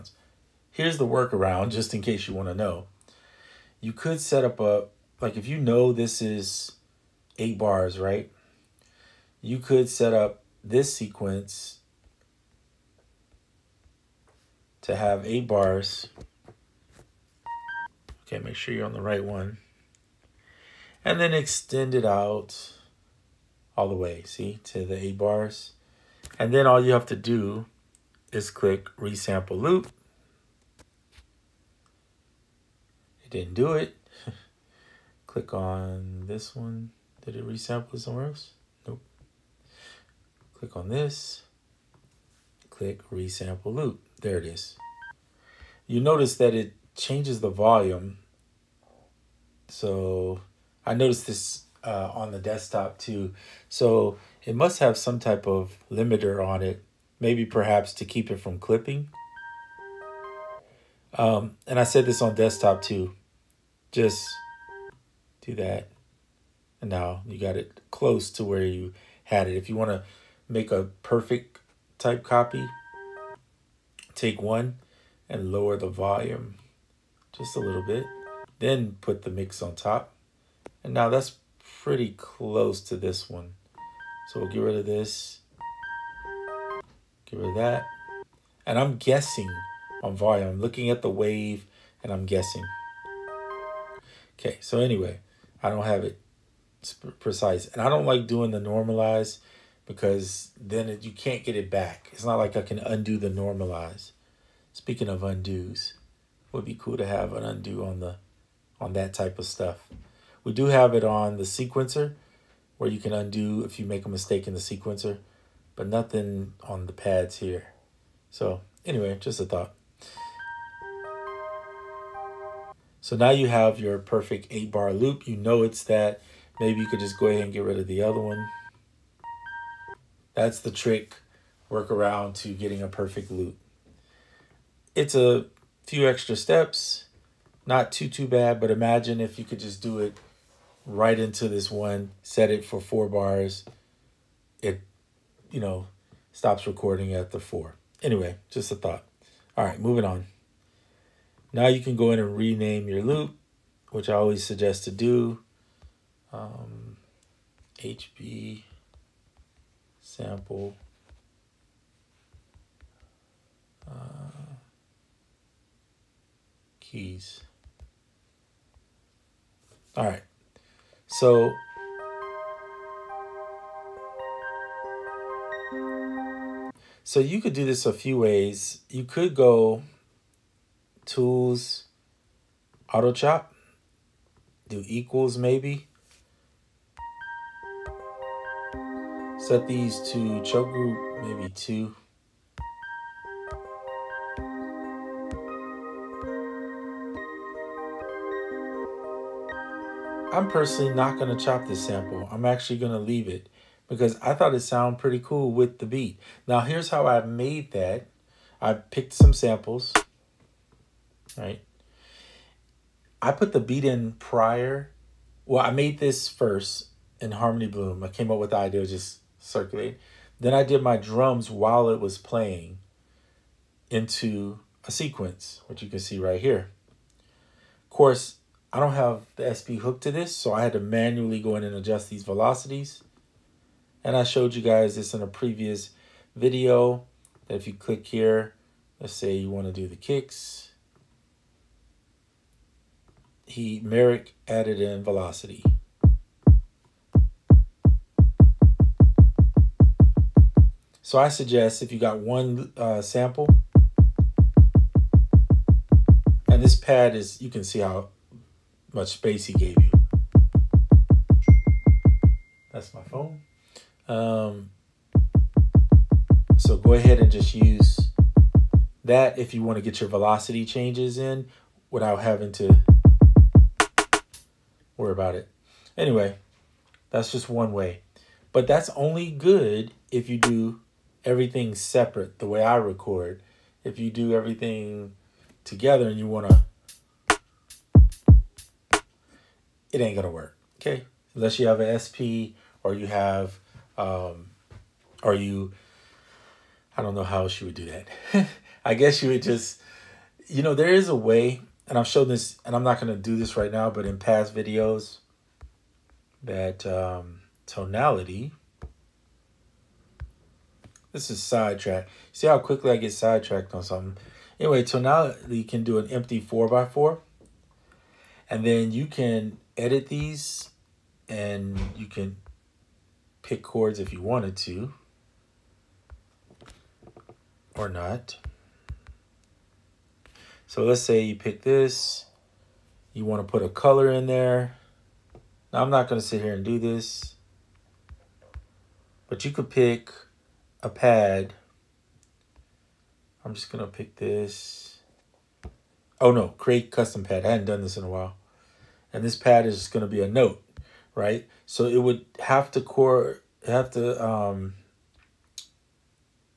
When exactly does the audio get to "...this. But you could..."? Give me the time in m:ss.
5:36.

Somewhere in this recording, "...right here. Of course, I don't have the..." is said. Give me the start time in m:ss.
3:46.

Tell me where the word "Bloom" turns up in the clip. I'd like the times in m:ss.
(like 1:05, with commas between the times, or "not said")
3:37.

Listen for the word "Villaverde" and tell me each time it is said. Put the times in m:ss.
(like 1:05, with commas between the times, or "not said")
not said.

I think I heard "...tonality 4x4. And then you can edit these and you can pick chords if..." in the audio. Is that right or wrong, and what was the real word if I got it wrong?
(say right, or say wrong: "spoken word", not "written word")
wrong: "empty", not "tonality".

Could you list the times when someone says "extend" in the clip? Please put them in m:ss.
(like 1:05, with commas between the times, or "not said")
0:21.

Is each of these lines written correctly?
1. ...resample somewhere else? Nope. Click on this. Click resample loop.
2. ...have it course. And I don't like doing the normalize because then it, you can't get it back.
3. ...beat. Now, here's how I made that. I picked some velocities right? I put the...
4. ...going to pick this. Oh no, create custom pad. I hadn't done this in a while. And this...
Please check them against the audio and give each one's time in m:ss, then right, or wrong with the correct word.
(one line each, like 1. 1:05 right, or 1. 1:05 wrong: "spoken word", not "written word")
1. 0:37 right
2. 1:35 wrong: "precise", not "course"
3. 3:25 wrong: "samples", not "velocities"
4. 5:43 right.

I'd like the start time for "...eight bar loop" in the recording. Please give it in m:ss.
2:04.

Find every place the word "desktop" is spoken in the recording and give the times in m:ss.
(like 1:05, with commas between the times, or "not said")
0:52, 1:02.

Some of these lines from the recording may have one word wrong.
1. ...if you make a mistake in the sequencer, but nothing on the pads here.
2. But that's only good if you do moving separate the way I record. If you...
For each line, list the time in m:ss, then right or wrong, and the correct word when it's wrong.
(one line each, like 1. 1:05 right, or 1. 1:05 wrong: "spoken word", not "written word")
1. 1:53 right
2. 4:38 wrong: "everything", not "moving".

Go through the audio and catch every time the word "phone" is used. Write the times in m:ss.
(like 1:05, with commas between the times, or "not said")
4:23.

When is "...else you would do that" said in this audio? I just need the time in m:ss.
4:57.